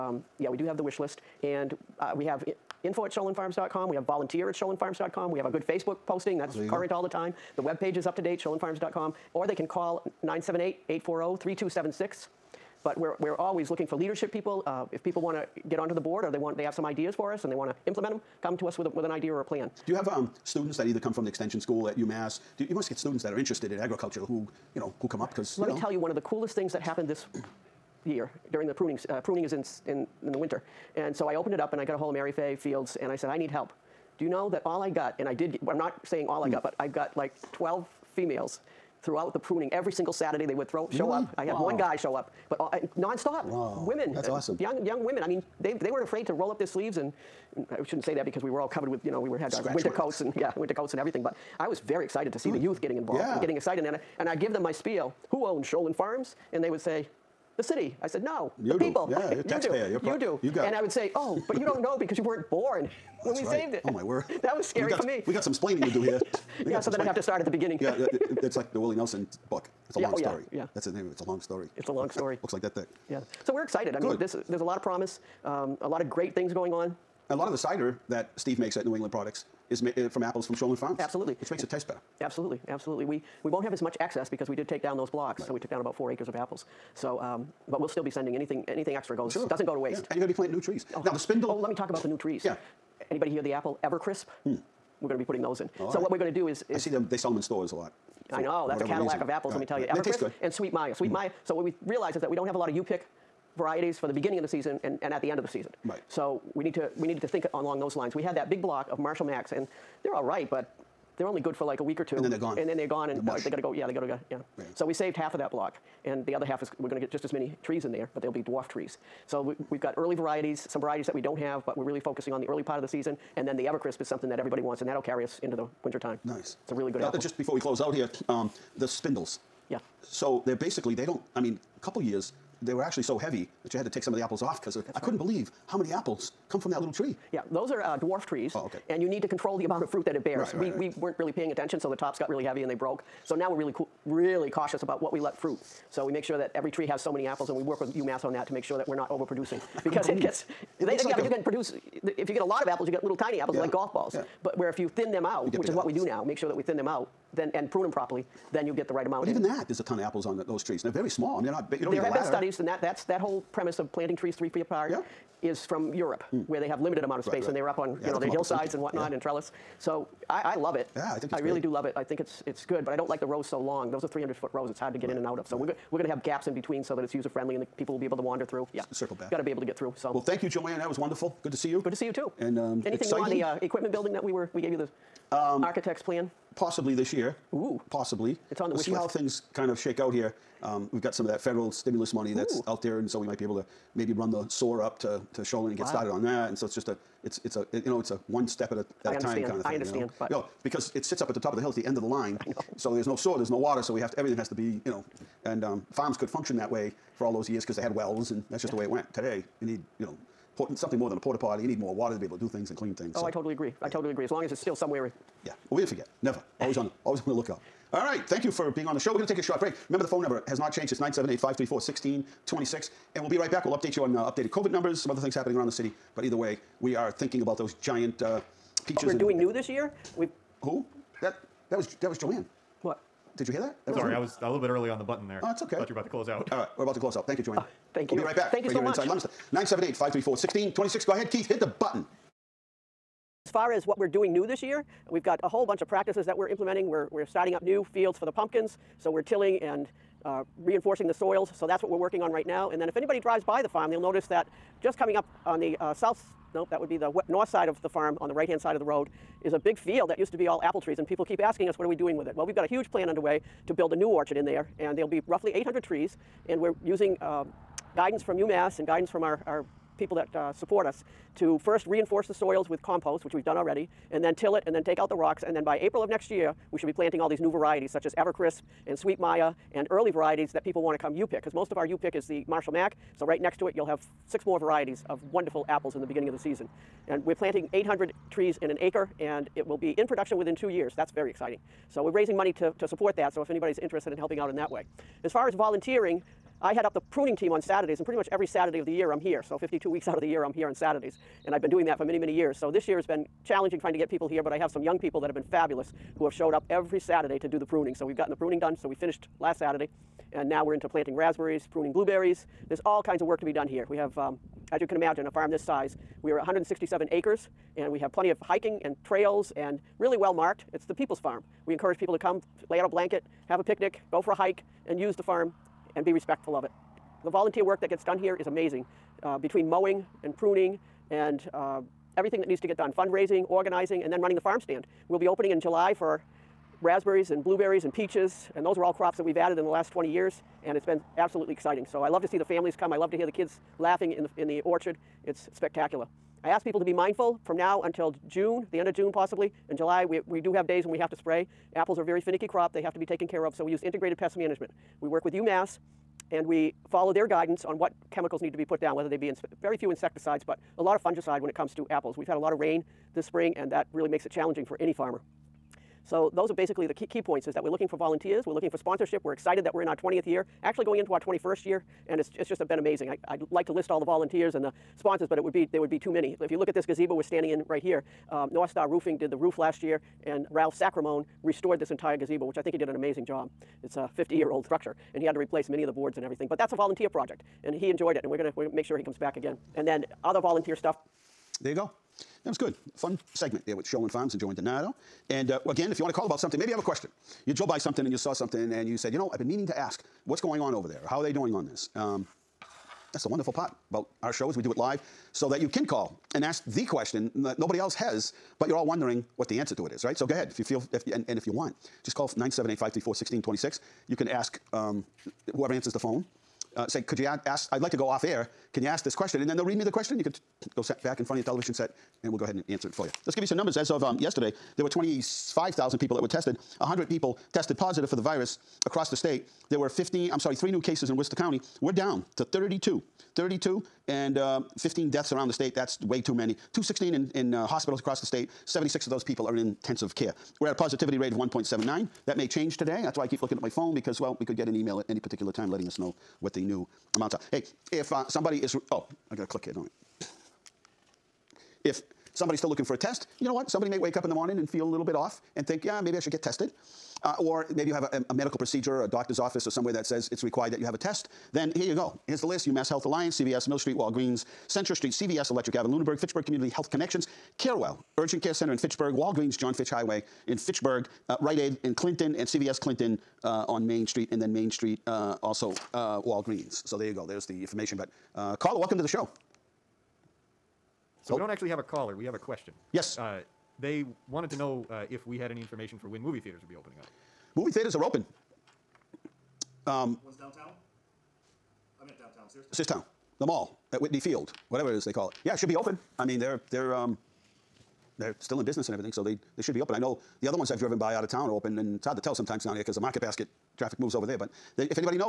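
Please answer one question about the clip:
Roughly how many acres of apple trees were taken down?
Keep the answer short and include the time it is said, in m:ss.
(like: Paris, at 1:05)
4, at 1:25.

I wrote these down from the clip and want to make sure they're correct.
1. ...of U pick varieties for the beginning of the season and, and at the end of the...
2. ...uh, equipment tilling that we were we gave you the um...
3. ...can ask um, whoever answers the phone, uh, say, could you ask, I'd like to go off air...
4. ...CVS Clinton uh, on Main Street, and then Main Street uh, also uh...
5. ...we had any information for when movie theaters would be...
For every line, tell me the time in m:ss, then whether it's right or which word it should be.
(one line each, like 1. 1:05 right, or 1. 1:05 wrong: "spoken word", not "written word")
1. 1:42 right
2. 3:03 wrong: "building", not "tilling"
3. 6:54 right
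4. 7:52 right
5. 8:05 right.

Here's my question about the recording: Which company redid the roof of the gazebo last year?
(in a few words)
North Star Roofing.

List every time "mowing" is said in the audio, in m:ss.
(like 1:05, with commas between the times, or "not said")
5:29.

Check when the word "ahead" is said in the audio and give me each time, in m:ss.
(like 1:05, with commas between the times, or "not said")
4:01, 6:50, 7:02.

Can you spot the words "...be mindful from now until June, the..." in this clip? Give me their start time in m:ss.
5:46.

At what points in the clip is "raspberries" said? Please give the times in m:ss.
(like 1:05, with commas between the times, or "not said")
5:11, 5:36.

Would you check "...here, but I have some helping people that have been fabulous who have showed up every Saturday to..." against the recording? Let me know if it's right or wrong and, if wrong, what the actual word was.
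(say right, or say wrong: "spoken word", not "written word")
wrong: "young", not "helping".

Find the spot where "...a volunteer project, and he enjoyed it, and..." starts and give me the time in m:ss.
6:26.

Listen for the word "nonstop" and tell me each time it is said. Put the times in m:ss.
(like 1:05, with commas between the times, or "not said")
0:42.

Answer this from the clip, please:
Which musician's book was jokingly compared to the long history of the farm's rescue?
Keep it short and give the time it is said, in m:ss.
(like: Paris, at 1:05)
Willie Nelson, at 1:08.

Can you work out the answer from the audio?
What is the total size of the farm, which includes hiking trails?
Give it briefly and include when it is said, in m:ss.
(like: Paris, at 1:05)
167 acres, at 5:16.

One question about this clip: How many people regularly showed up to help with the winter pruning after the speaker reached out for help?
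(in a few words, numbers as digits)
12.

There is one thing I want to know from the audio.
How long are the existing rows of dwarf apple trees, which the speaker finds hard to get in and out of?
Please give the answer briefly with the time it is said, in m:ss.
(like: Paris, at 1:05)
300 feet, at 2:54.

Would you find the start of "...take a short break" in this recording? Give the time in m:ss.
3:39.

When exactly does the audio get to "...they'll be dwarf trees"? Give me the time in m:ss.
1:58.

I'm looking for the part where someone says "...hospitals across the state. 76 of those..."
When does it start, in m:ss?
7:17.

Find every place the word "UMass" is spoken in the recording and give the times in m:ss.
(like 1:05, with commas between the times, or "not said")
0:21, 2:27, 4:28, 5:55, 7:42.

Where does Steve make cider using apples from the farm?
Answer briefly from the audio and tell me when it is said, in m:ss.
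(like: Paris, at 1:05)
New England Products, at 1:18.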